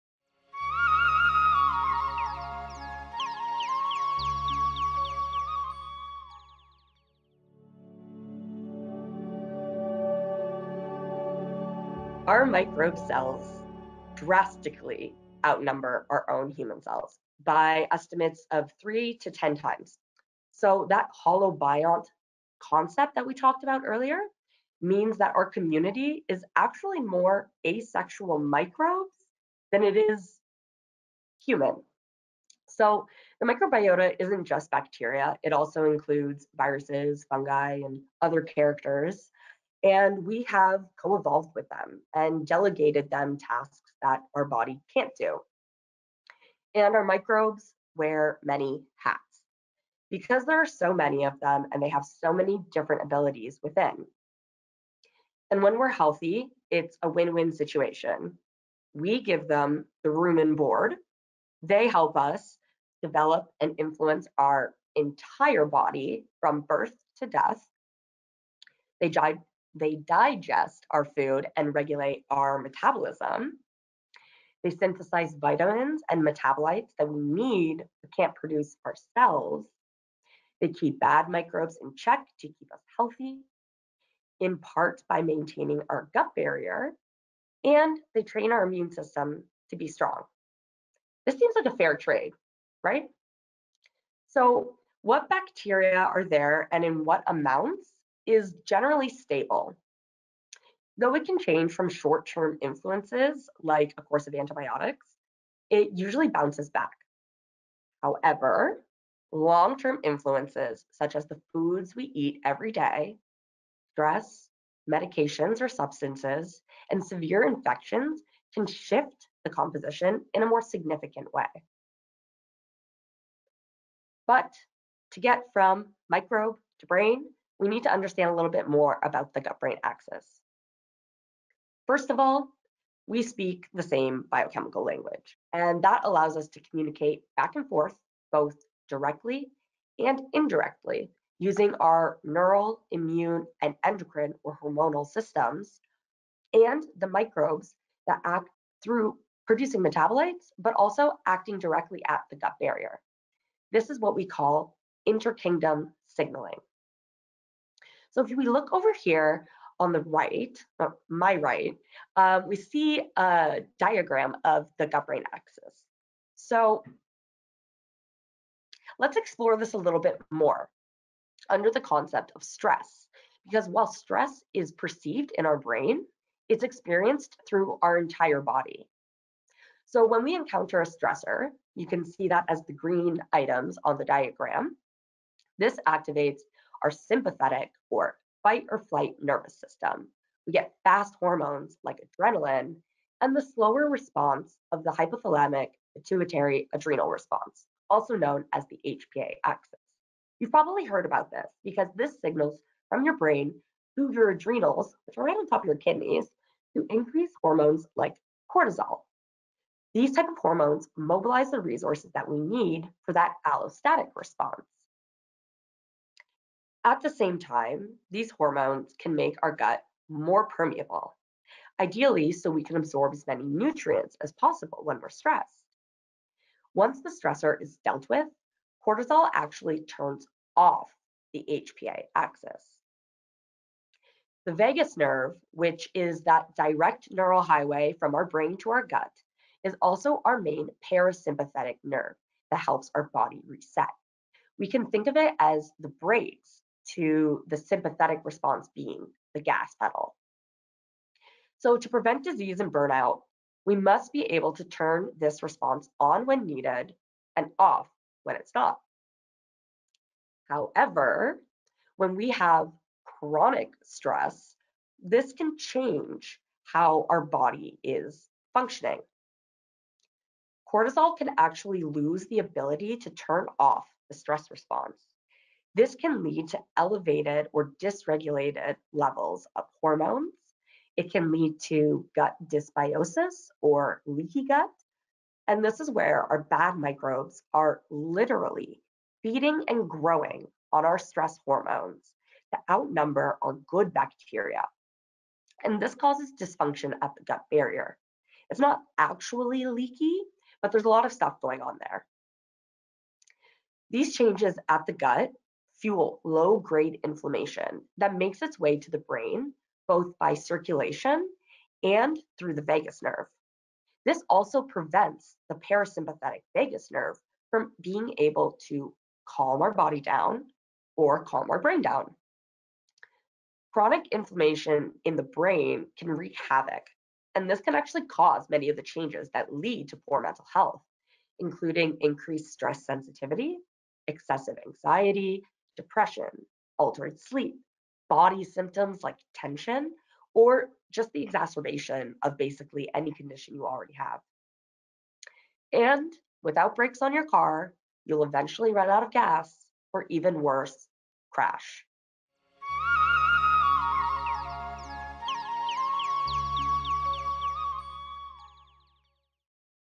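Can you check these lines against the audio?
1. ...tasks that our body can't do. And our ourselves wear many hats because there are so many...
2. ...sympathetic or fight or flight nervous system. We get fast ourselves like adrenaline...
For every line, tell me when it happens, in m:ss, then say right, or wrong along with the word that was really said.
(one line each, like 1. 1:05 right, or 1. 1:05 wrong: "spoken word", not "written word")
1. 0:43 wrong: "microbes", not "ourselves"
2. 3:06 wrong: "hormones", not "ourselves".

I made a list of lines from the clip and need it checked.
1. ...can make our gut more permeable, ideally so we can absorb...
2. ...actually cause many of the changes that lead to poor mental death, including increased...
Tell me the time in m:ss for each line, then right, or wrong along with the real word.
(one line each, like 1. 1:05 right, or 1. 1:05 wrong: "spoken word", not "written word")
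1. 3:38 right
2. 5:27 wrong: "health", not "death".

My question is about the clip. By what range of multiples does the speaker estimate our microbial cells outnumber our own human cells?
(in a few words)
3 to 10 times.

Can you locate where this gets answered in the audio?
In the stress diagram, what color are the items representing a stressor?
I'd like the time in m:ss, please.
3:02.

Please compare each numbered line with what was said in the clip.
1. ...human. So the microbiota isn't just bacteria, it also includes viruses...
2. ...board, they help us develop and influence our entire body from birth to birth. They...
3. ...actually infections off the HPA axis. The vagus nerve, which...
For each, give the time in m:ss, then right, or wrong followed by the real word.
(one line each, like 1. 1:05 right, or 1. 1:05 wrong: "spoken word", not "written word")
1. 0:31 right
2. 1:00 wrong: "death", not "birth"
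3. 3:49 wrong: "turns", not "infections".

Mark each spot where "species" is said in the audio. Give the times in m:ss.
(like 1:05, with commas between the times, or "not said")
not said.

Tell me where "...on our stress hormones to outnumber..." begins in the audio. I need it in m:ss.
4:50.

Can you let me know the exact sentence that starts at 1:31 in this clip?
This seems like a fair trade, right?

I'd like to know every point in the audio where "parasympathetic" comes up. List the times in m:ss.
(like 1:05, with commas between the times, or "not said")
4:00, 5:15.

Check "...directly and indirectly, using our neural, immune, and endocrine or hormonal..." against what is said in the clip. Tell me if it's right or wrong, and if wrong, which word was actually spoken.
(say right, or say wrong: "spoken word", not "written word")
right.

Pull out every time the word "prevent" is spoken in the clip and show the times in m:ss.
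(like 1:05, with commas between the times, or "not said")
4:11, 5:14.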